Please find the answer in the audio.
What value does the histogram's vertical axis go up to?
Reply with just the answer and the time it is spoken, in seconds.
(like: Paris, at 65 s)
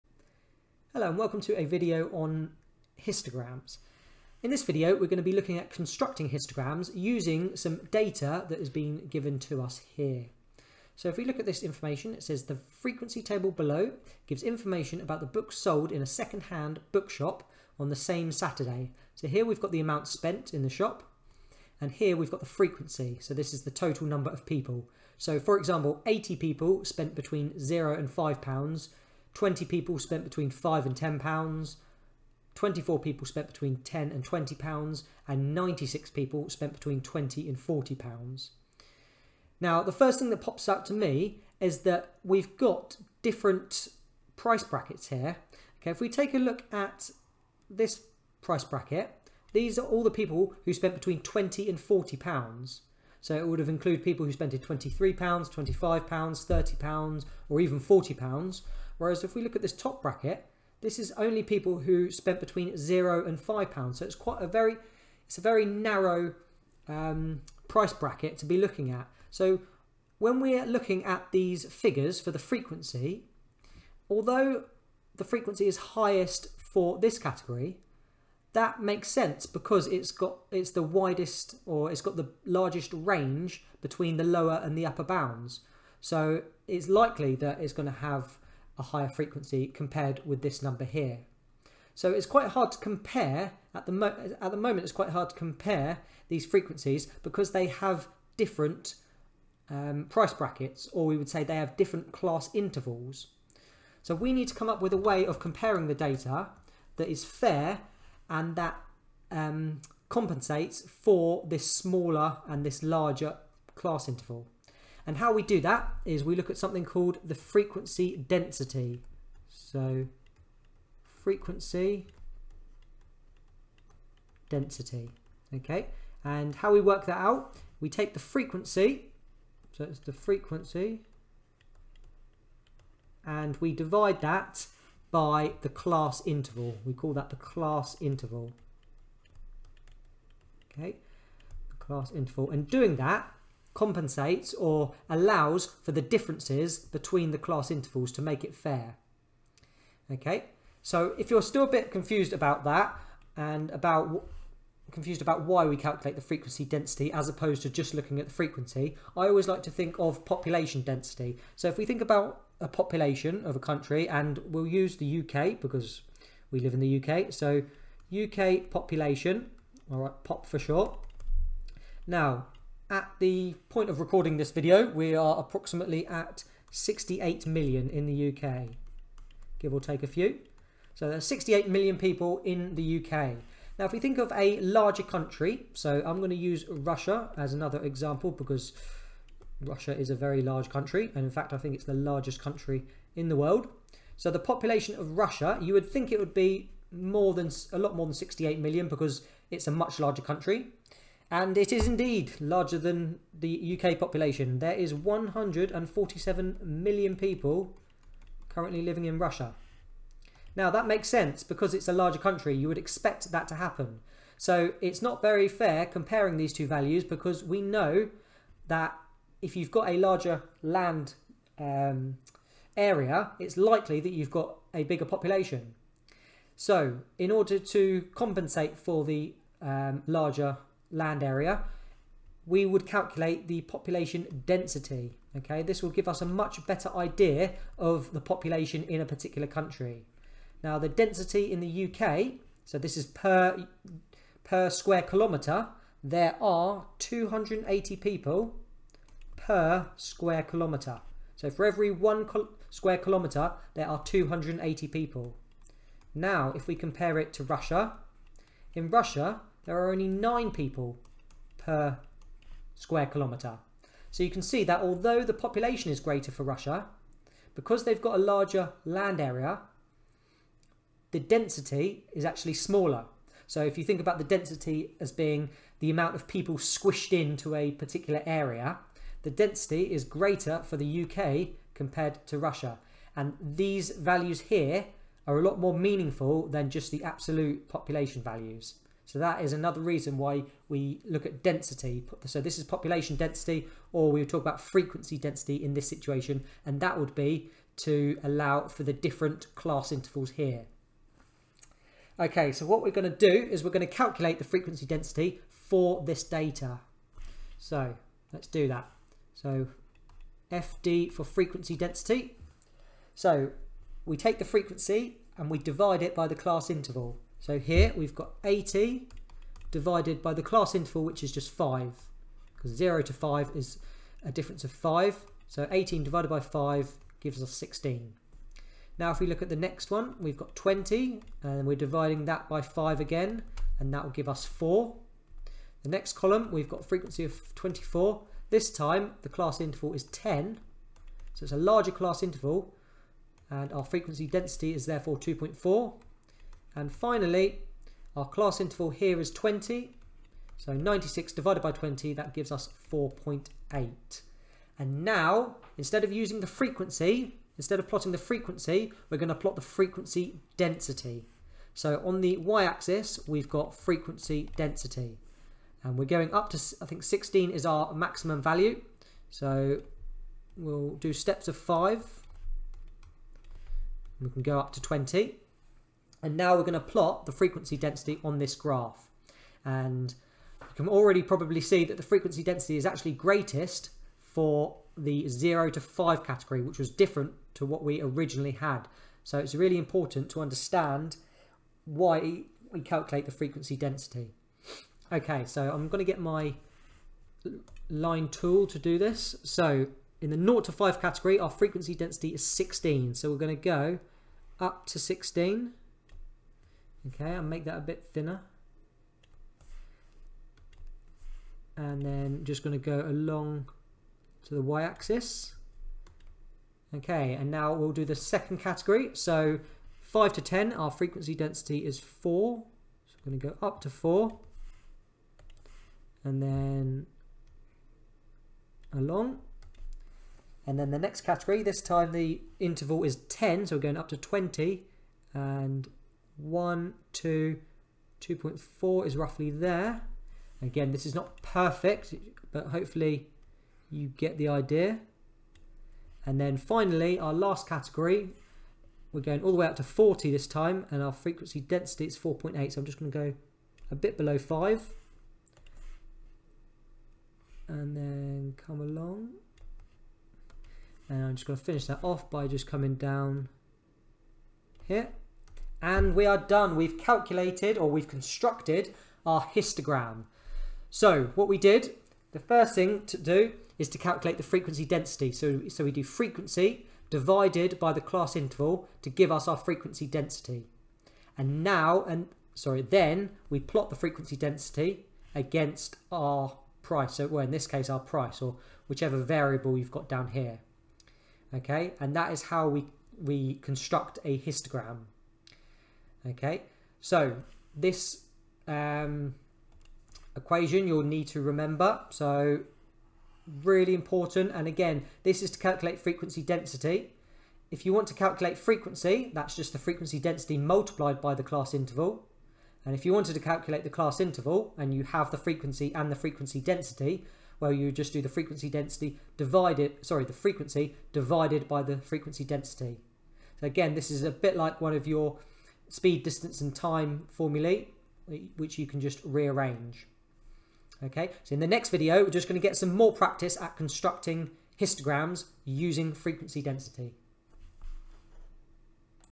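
20, at 374 s.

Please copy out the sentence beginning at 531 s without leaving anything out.
Okay, so in the next video, we're just going to get some more practice at constructing histograms using frequency density.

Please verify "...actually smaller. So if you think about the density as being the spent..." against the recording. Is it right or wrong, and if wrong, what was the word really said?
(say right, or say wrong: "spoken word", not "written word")
wrong: "amount", not "spent".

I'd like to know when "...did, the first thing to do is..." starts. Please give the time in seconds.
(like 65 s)
471 s.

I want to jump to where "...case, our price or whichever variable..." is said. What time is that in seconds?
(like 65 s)
487 s.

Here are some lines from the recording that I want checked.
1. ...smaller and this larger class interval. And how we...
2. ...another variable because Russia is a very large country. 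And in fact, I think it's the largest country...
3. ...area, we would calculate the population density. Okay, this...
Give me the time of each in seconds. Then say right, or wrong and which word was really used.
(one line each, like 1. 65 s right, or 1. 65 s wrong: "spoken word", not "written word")
1. 111 s right
2. 187 s wrong: "example", not "variable"
3. 231 s right.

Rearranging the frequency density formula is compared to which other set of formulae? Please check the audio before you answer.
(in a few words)
speed, distance and time.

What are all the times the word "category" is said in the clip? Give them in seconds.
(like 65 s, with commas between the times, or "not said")
77 s, 386 s, 401 s, 418 s, 431 s, 447 s.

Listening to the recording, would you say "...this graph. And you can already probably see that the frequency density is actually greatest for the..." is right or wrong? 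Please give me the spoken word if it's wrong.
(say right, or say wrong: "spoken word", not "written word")
right.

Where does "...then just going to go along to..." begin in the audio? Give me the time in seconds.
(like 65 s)
412 s.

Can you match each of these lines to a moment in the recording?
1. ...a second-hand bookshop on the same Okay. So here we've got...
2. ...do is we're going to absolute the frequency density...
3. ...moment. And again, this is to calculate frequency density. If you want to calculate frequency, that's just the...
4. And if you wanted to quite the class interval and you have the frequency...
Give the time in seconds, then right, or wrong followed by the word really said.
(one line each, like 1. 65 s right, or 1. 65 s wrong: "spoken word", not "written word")
1. 16 s wrong: "Saturday", not "Okay"
2. 303 s wrong: "calculate", not "absolute"
3. 503 s wrong: "important", not "moment"
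4. 512 s wrong: "calculate", not "quite".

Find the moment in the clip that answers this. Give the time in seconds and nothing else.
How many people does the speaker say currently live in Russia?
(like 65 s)
204 s.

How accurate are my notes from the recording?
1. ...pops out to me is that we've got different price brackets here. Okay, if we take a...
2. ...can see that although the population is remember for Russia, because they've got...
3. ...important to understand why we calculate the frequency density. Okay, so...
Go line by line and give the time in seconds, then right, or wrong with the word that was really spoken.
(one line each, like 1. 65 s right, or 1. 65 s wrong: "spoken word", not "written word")
1. 40 s right
2. 264 s wrong: "greater", not "remember"
3. 389 s right.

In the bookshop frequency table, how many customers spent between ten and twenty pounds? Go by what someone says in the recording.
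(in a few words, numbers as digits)
24.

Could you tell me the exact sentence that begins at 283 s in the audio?
And these values here are a lot more meaningful than just the absolute population values.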